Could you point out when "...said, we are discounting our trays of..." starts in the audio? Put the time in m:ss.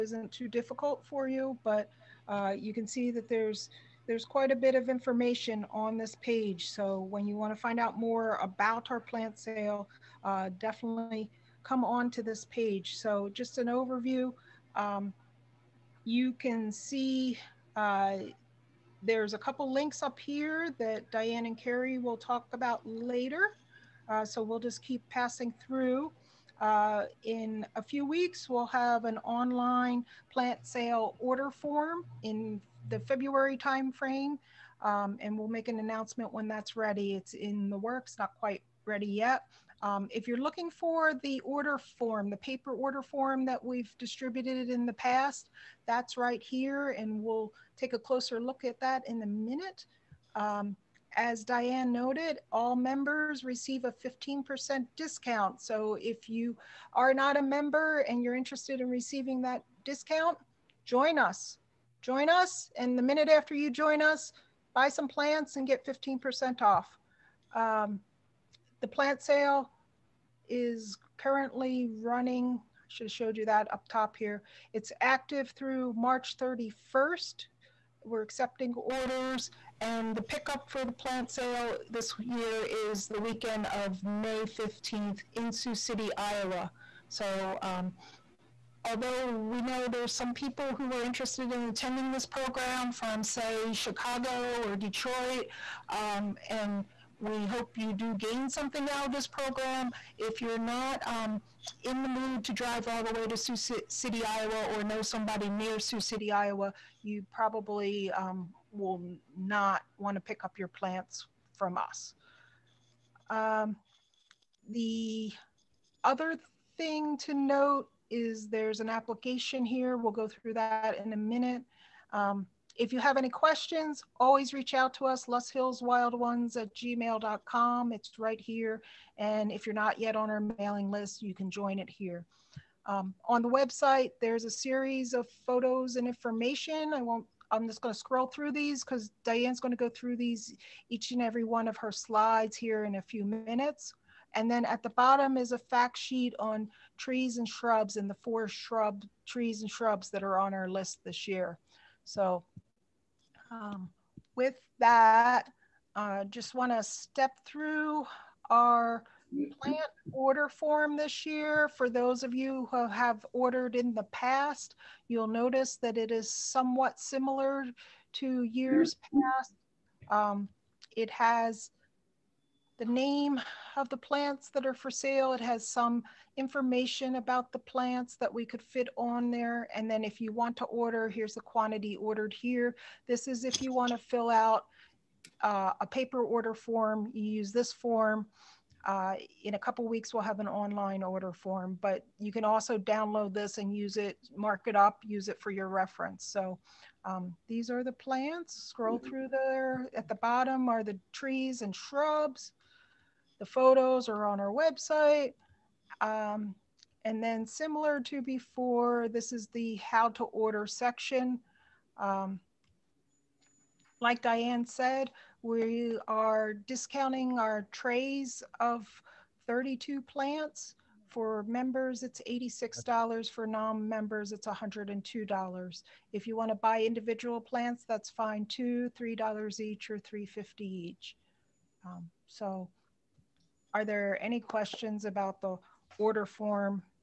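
3:34.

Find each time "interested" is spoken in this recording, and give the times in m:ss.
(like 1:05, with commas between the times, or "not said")
0:58, 1:31.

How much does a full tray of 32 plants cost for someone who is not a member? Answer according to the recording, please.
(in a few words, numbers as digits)
$102.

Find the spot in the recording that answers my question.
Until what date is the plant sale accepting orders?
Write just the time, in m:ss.
1:15.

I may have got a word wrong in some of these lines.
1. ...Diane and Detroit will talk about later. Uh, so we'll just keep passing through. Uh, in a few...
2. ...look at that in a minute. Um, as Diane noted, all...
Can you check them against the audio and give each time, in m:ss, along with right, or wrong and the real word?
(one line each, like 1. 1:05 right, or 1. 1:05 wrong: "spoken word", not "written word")
1. 0:21 wrong: "Carrie", not "Detroit"
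2. 0:48 right.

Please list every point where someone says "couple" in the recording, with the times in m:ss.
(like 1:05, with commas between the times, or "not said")
0:19, 3:09.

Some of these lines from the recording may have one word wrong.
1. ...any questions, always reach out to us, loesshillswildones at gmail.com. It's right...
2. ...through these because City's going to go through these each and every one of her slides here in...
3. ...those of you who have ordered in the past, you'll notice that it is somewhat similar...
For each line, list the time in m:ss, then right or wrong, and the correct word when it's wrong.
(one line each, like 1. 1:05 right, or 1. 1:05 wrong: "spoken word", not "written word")
1. 2:03 right
2. 2:18 wrong: "Diane", not "City"
3. 2:41 right.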